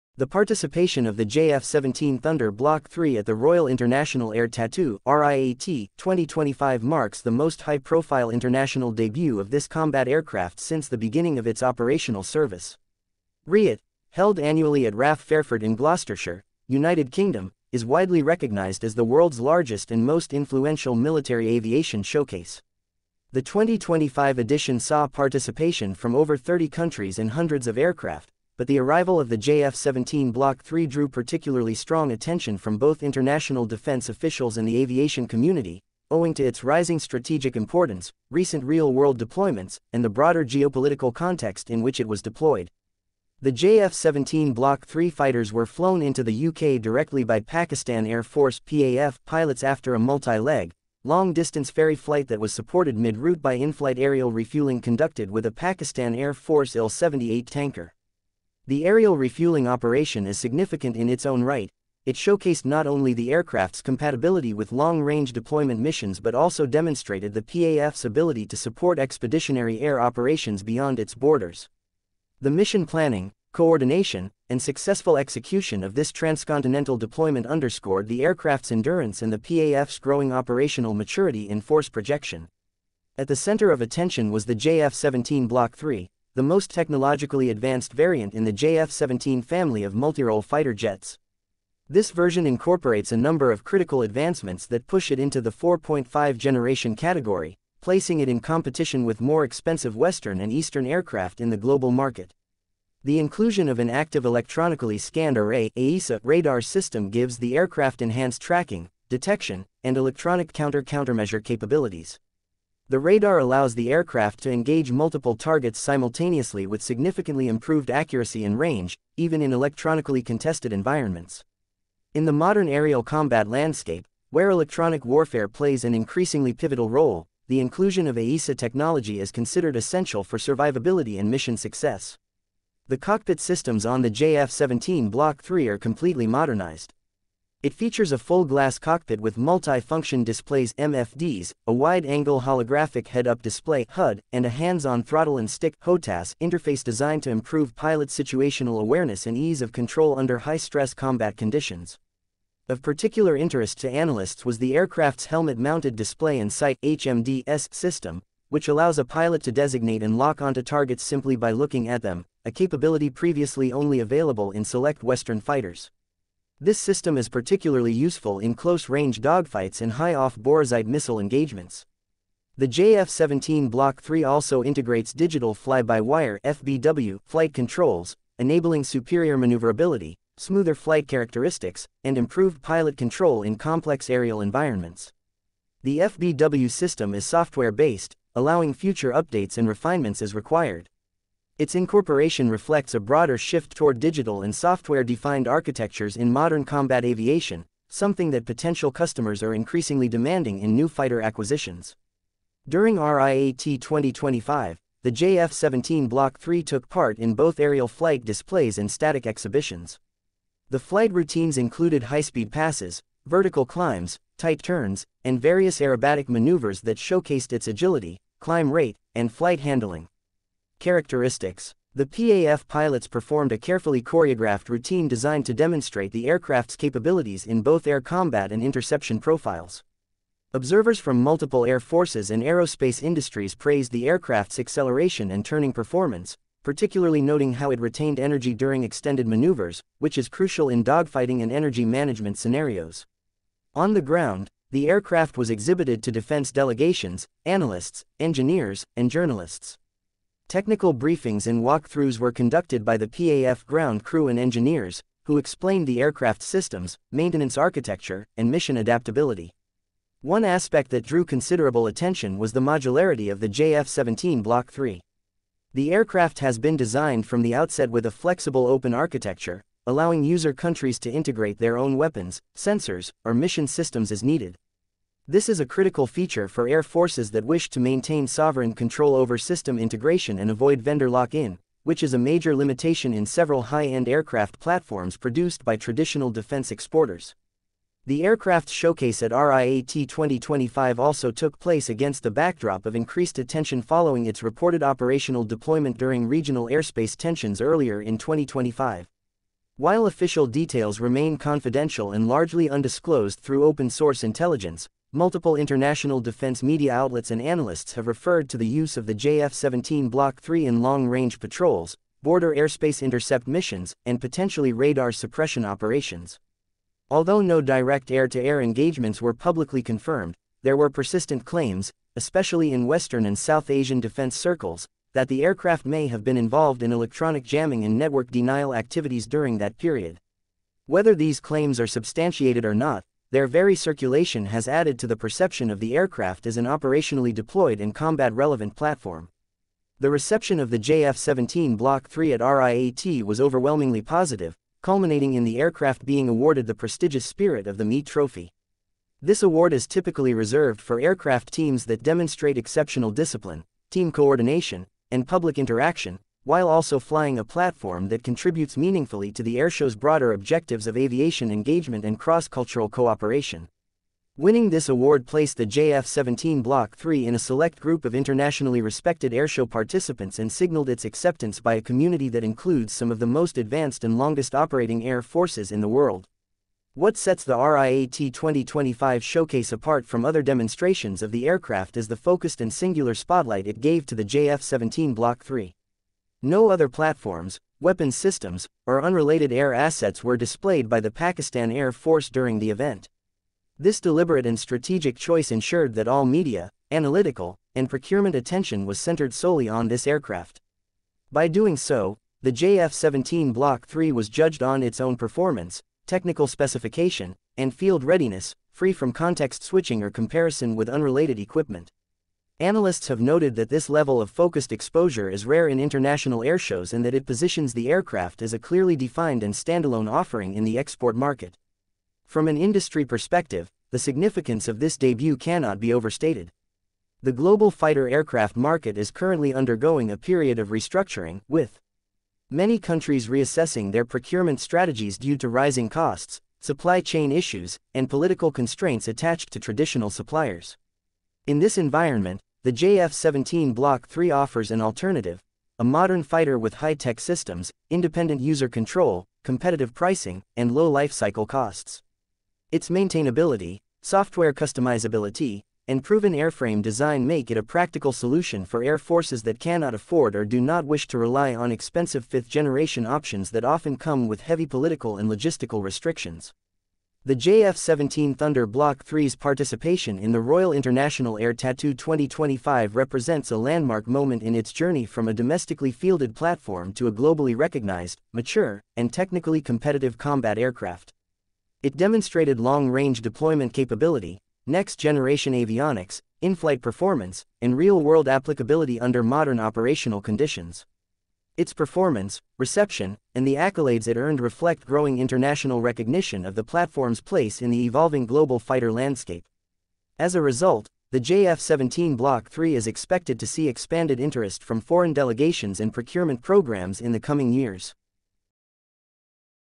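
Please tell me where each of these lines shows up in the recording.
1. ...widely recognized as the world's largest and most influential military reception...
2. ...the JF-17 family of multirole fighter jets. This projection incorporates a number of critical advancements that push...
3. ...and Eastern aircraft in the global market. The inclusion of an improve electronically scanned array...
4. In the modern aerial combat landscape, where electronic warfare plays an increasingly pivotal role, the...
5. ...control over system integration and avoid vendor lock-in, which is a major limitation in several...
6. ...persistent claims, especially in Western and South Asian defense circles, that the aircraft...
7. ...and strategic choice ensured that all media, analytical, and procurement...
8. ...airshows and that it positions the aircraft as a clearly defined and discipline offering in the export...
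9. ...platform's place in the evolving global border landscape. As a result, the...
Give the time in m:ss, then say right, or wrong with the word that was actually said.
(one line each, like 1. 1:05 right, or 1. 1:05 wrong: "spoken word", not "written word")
1. 0:17 wrong: "aviation", not "reception"
2. 1:28 wrong: "version", not "projection"
3. 1:40 wrong: "active", not "improve"
4. 2:02 right
5. 4:38 right
6. 5:20 right
7. 6:34 right
8. 6:56 wrong: "standalone", not "discipline"
9. 8:16 wrong: "fighter", not "border".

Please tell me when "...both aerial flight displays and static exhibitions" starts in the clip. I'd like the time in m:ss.
3:27.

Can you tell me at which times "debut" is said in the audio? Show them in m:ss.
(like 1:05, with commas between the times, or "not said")
0:08, 7:04.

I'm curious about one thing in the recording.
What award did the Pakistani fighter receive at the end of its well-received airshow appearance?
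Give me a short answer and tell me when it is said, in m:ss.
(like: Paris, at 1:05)
Spirit of the Meet Trophy, at 5:47.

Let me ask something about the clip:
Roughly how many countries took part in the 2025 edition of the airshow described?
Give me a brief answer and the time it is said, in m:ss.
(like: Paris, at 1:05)
over 30, at 0:26.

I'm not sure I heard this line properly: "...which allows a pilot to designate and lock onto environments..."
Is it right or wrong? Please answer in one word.
wrong.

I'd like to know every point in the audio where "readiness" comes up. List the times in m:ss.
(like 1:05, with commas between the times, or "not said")
6:48.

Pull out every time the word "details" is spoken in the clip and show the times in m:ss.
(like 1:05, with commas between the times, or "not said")
5:00.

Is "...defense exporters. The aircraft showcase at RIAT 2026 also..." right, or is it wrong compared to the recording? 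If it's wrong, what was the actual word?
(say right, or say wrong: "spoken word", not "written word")
wrong: "2025", not "2026".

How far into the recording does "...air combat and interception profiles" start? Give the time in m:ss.
3:47.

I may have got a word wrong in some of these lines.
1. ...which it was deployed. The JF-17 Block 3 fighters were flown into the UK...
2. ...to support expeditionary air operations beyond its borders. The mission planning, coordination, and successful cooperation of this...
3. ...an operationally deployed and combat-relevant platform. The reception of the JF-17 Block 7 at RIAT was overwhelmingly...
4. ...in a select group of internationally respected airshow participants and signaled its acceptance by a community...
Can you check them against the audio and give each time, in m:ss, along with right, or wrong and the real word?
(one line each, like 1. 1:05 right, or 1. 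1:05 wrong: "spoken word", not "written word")
1. 0:41 right
2. 1:08 wrong: "execution", not "cooperation"
3. 5:36 wrong: "3", not "7"
4. 6:07 right.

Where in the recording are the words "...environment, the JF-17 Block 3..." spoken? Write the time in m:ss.
7:21.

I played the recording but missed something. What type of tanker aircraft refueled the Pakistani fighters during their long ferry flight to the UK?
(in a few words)
Il-78.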